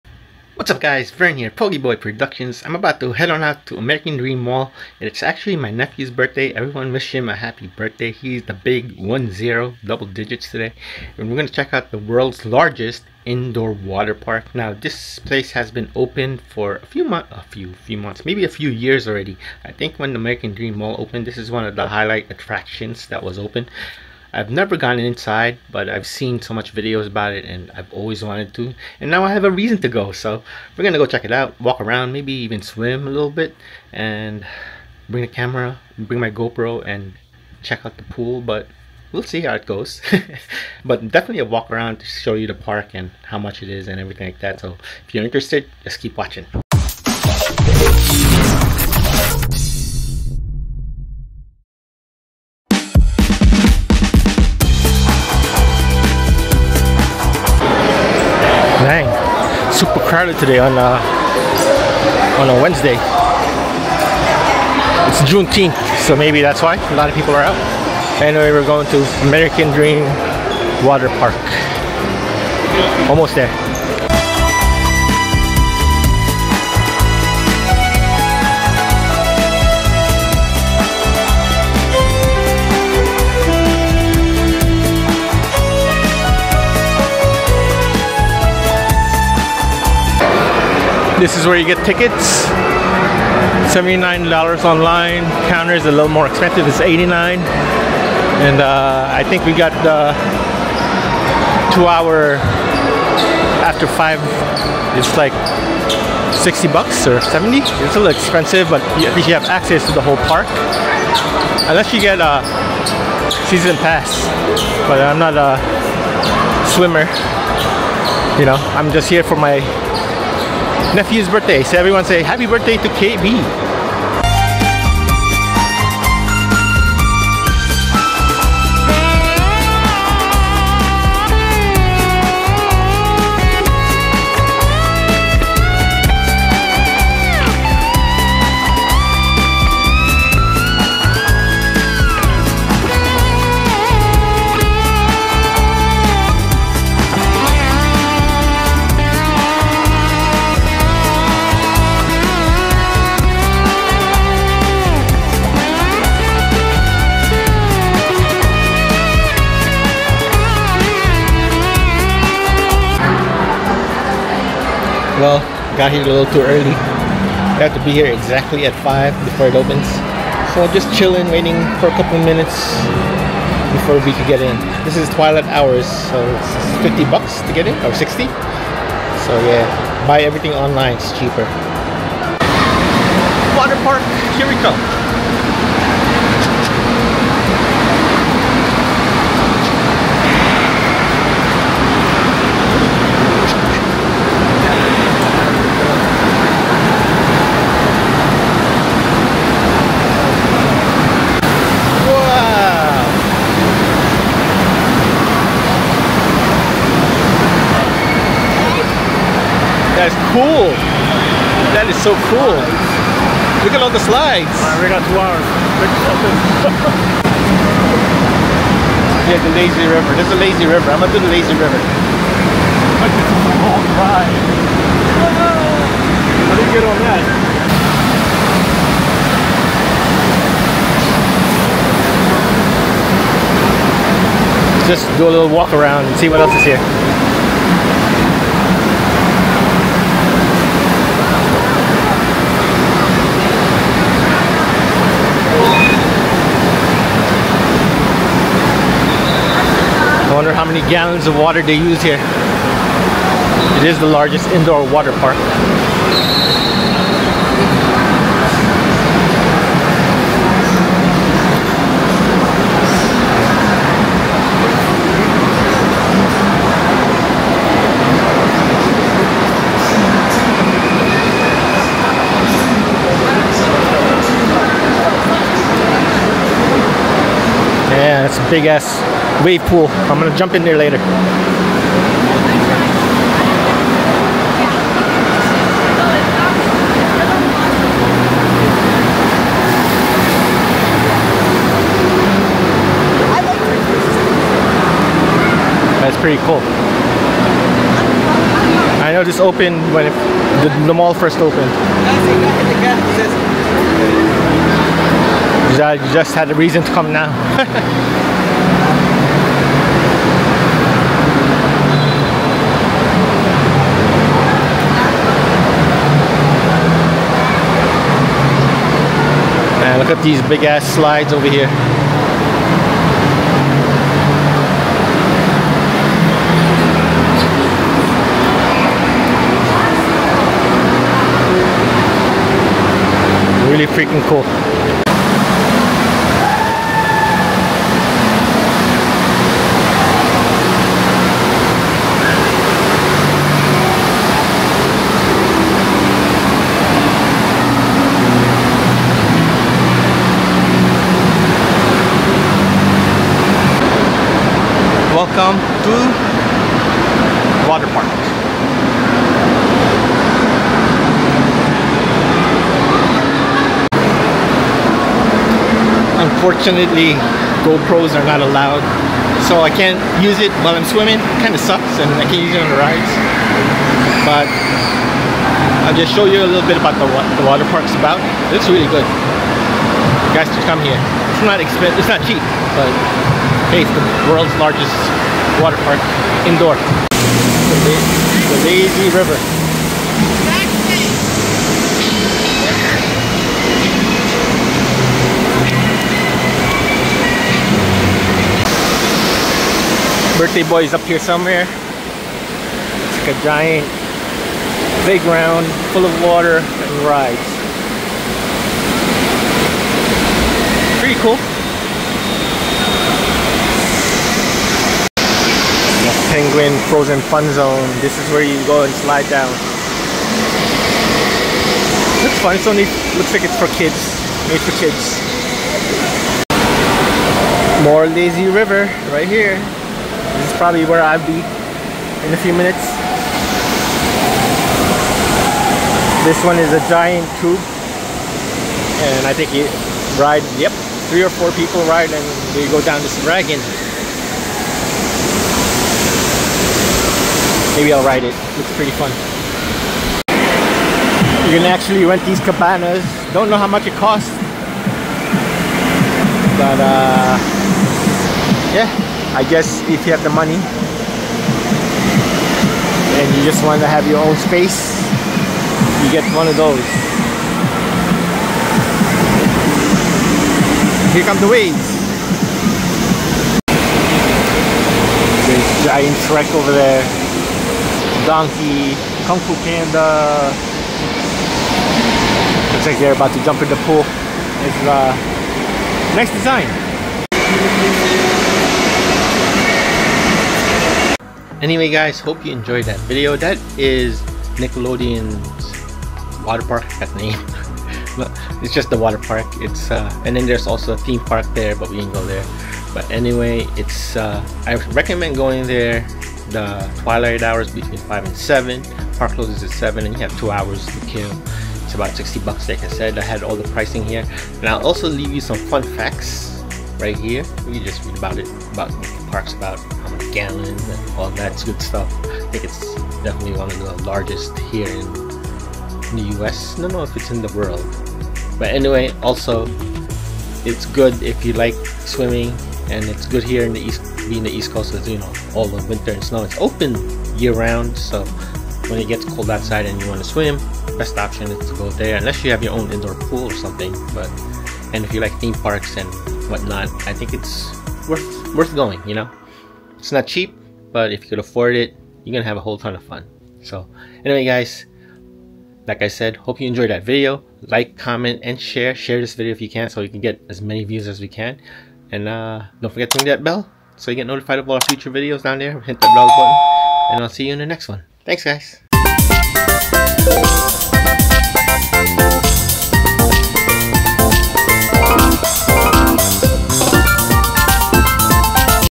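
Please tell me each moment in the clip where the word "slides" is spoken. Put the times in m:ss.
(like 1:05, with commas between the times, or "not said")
3:34, 5:20, 6:59.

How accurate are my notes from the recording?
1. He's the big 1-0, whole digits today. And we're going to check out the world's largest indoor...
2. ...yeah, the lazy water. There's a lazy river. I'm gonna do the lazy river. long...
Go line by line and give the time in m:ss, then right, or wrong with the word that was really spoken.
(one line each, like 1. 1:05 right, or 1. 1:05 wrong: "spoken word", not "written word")
1. 0:08 wrong: "double", not "whole"
2. 3:39 wrong: "river", not "water".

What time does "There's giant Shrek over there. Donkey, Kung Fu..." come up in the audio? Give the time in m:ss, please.
7:55.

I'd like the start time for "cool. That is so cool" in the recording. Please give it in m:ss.
3:30.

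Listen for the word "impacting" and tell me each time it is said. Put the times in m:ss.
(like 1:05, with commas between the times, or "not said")
not said.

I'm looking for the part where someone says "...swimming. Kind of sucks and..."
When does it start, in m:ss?
6:10.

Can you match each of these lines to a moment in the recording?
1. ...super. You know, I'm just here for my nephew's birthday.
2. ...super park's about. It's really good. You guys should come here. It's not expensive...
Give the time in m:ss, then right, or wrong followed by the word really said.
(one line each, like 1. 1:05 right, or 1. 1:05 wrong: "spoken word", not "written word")
1. 1:56 wrong: "swimmer", not "super"
2. 6:17 wrong: "water", not "super".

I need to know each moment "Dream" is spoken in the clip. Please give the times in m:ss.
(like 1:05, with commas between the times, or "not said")
0:04, 0:20, 1:09.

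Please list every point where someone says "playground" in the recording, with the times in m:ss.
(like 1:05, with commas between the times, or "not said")
6:45.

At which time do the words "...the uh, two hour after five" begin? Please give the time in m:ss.
1:39.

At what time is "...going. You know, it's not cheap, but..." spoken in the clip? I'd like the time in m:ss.
9:08.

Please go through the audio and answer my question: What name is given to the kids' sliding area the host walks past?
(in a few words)
Penguin Frozen Fun Zone.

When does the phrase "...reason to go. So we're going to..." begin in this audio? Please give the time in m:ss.
0:29.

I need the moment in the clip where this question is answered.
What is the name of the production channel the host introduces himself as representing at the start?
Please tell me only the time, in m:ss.
0:01.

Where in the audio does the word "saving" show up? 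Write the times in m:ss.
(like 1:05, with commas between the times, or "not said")
not said.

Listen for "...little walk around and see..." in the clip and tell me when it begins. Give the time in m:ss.
3:55.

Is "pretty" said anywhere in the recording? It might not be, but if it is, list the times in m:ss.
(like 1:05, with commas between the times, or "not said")
6:50, 7:28.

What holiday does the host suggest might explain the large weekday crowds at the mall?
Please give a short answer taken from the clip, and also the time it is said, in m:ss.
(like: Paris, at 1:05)
Juneteenth, at 1:05.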